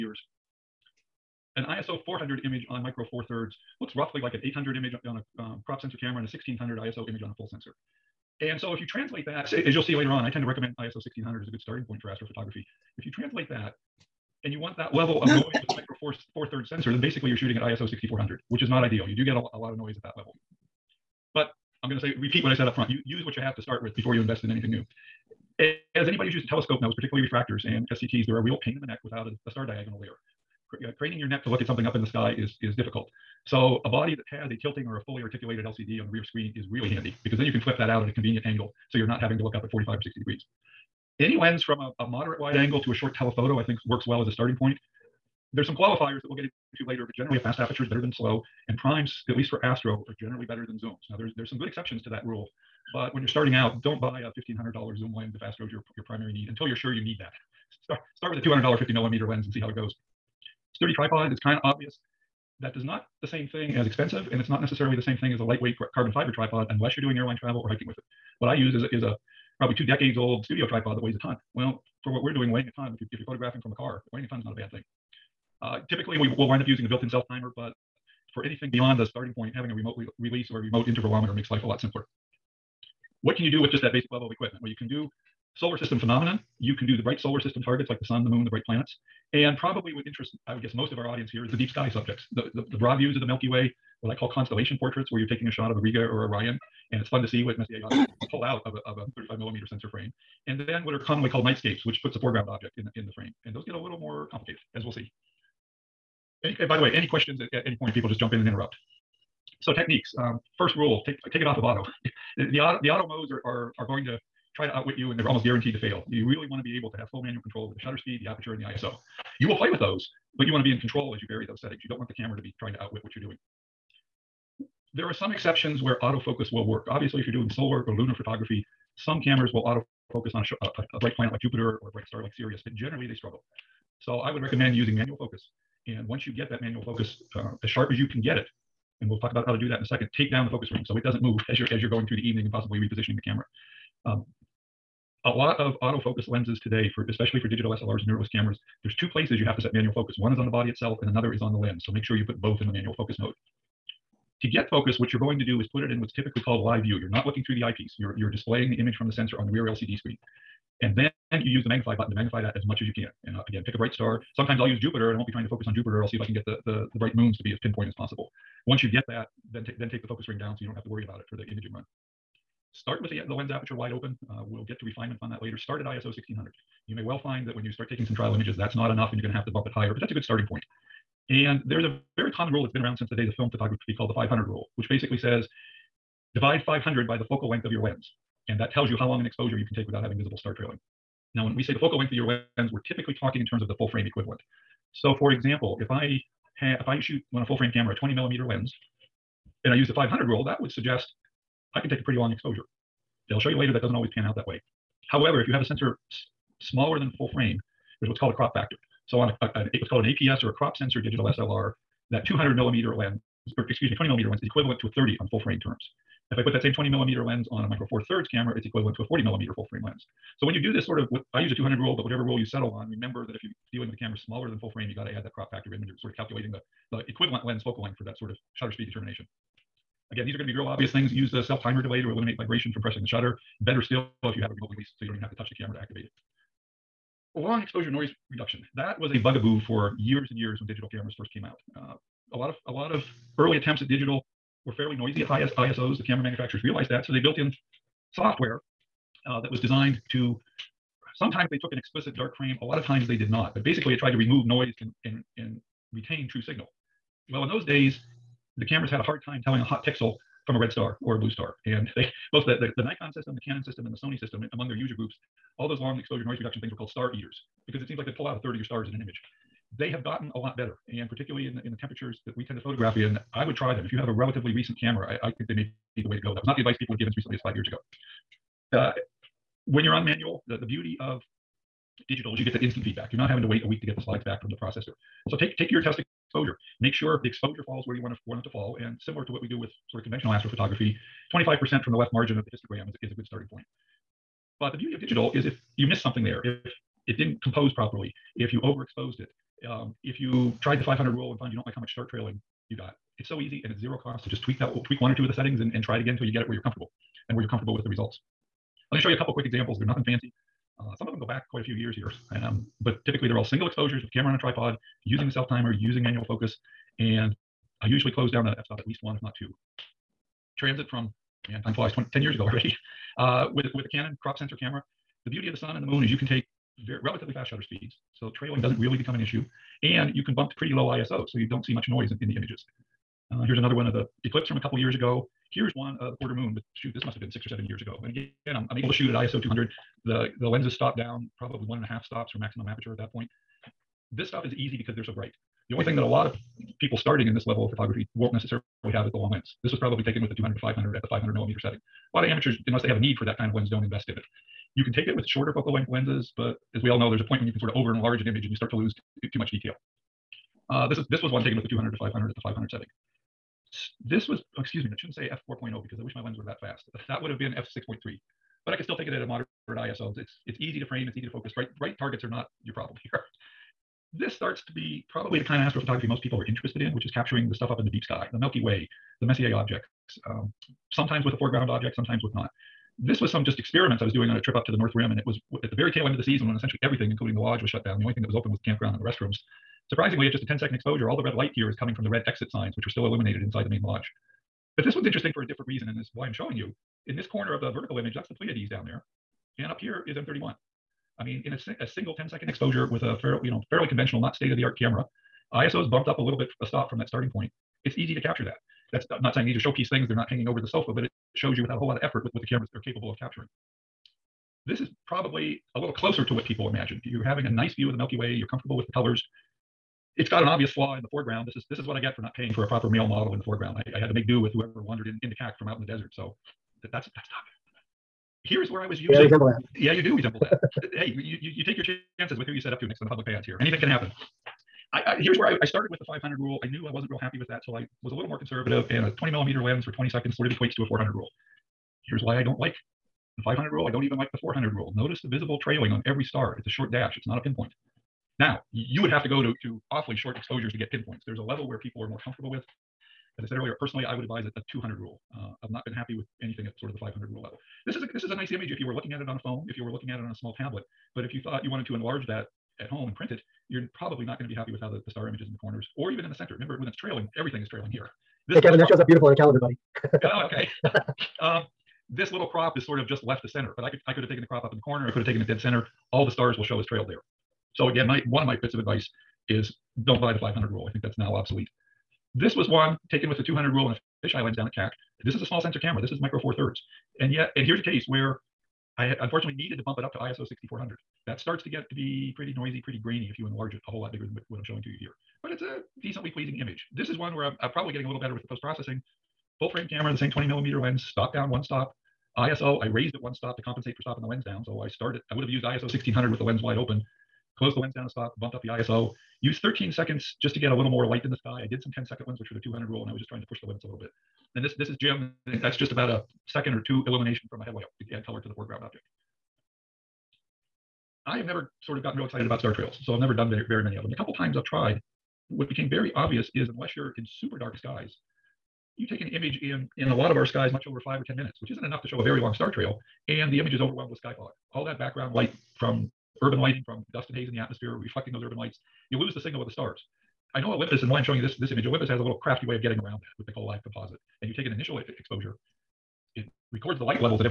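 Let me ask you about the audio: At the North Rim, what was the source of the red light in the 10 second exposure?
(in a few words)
red exit signs.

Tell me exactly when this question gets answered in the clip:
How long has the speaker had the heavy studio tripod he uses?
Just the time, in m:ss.
1:09.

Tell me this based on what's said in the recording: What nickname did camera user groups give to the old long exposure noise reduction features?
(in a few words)
star eaters.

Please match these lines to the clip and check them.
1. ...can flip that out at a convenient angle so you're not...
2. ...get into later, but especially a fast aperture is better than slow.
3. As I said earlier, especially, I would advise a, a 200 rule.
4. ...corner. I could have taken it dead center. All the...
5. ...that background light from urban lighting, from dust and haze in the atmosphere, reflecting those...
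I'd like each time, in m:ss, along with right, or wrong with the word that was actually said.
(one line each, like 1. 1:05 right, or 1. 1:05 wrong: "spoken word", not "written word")
1. 0:37 right
2. 0:46 wrong: "generally", not "especially"
3. 7:33 wrong: "personally", not "especially"
4. 7:54 right
5. 8:54 right.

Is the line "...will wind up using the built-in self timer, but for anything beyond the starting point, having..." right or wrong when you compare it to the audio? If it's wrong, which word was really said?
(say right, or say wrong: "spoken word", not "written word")
right.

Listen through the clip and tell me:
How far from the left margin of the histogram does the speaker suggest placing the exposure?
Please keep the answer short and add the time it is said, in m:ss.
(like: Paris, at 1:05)
25%, at 4:51.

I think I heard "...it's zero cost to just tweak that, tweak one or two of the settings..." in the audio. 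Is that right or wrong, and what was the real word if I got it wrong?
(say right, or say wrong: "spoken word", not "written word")
right.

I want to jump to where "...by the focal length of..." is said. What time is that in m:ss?
3:07.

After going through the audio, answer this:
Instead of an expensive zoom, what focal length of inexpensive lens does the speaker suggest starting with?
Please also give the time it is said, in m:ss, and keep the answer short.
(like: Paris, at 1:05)
50 millimeter, at 0:58.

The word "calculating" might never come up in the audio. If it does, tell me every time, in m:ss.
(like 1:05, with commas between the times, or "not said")
3:46.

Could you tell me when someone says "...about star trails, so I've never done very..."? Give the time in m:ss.
8:42.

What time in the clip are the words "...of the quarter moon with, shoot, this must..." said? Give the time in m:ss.
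5:36.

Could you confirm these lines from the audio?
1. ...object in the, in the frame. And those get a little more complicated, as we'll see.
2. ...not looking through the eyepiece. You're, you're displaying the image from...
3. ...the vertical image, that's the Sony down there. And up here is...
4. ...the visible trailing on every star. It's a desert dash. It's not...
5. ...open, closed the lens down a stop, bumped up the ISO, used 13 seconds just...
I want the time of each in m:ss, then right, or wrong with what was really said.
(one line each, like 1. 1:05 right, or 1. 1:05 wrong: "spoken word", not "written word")
1. 1:42 right
2. 2:37 right
3. 6:37 wrong: "Pleiades", not "Sony"
4. 7:25 wrong: "short", not "desert"
5. 8:26 right.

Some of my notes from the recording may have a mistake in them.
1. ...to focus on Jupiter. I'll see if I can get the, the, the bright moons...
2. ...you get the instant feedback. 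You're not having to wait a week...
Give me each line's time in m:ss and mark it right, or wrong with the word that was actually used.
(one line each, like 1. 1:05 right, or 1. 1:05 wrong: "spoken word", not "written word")
1. 2:45 right
2. 4:42 right.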